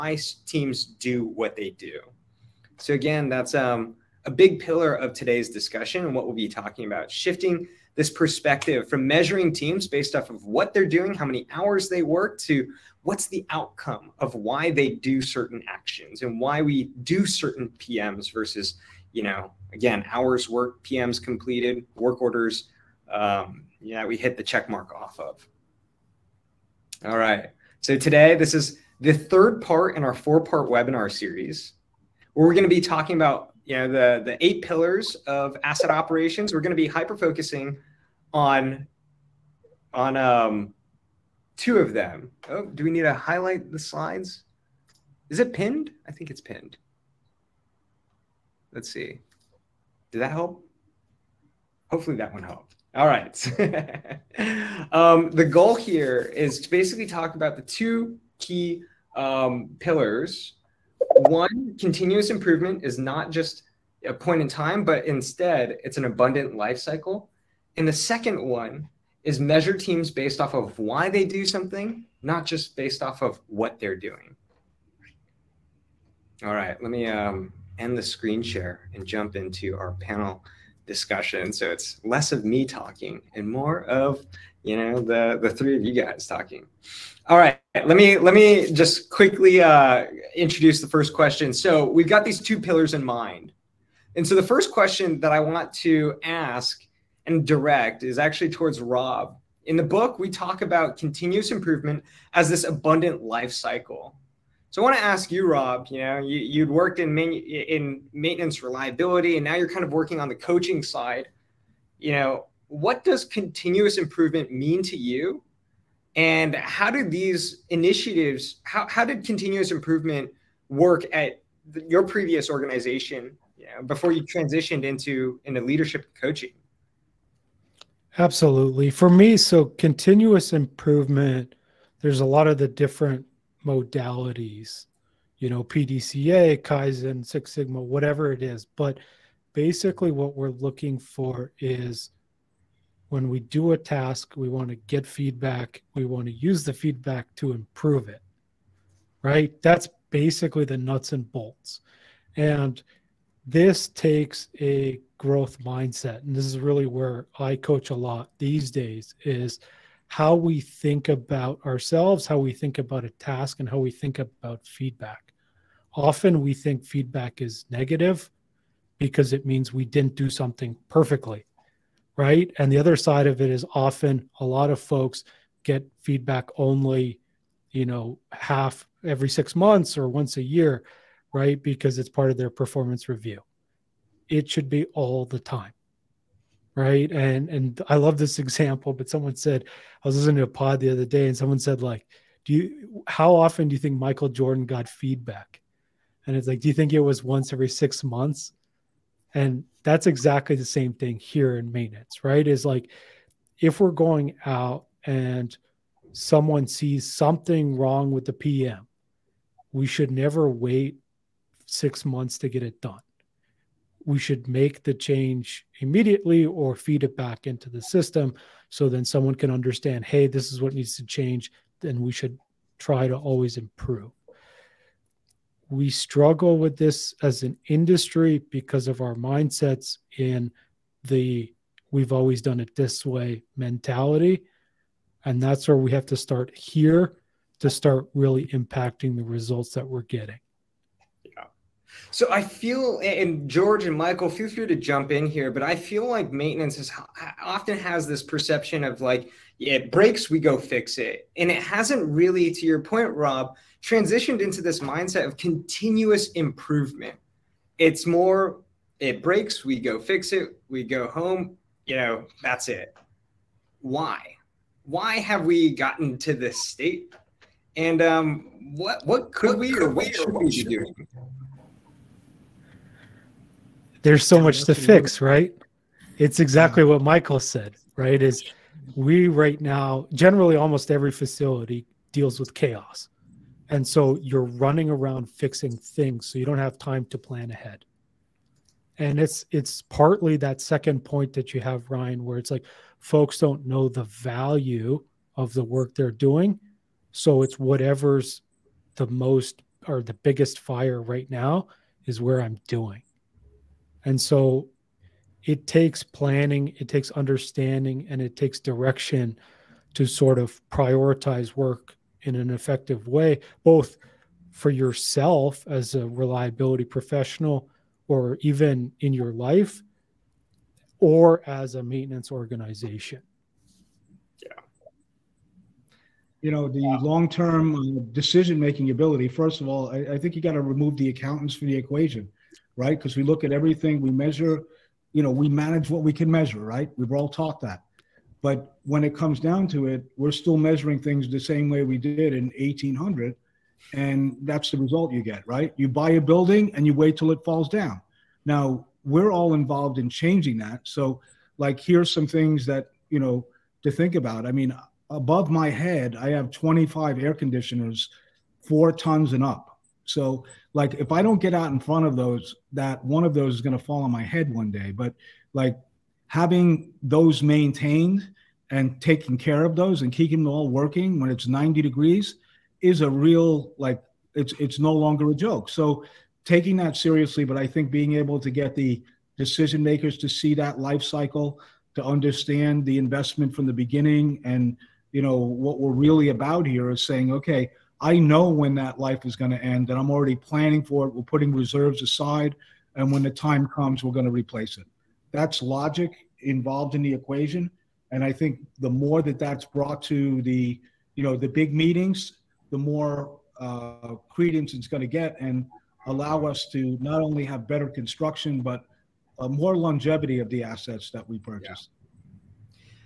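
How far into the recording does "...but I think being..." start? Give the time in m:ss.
6:17.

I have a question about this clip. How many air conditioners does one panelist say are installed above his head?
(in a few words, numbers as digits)
25.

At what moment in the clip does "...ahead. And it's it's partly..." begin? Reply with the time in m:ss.
4:47.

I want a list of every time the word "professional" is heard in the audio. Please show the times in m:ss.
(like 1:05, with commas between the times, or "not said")
5:16.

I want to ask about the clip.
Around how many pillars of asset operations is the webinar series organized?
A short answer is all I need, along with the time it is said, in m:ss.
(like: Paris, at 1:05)
8, at 0:34.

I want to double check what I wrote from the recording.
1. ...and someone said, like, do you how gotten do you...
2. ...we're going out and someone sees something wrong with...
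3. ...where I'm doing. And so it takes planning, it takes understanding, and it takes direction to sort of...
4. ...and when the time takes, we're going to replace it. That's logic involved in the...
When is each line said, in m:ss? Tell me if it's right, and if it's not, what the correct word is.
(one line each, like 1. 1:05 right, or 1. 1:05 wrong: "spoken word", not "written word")
1. 3:11 wrong: "often", not "gotten"
2. 3:23 right
3. 5:02 right
4. 6:32 wrong: "comes", not "takes".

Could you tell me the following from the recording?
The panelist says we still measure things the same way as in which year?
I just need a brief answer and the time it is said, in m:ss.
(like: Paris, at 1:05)
1800, at 5:42.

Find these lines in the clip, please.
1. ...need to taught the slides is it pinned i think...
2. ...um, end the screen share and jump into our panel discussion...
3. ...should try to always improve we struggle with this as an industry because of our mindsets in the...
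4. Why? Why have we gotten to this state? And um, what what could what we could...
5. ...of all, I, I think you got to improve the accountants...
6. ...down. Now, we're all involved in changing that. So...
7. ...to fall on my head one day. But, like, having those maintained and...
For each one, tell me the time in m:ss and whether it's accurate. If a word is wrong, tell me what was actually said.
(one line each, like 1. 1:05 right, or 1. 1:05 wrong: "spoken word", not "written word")
1. 0:42 wrong: "highlight", not "taught"
2. 1:17 right
3. 3:42 right
4. 4:23 right
5. 5:29 wrong: "remove", not "improve"
6. 5:47 right
7. 6:03 right.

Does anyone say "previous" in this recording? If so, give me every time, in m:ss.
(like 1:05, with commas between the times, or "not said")
2:02.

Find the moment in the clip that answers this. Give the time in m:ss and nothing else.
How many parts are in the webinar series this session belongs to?
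0:30.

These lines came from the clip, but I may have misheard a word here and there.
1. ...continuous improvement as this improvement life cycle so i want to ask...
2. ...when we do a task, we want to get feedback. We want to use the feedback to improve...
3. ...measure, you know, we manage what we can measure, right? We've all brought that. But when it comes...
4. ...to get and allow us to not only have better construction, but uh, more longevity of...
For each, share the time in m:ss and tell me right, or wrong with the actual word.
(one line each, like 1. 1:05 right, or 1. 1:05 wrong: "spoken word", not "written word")
1. 1:40 wrong: "abundant", not "improvement"
2. 2:23 right
3. 5:34 wrong: "taught", not "brought"
4. 6:45 right.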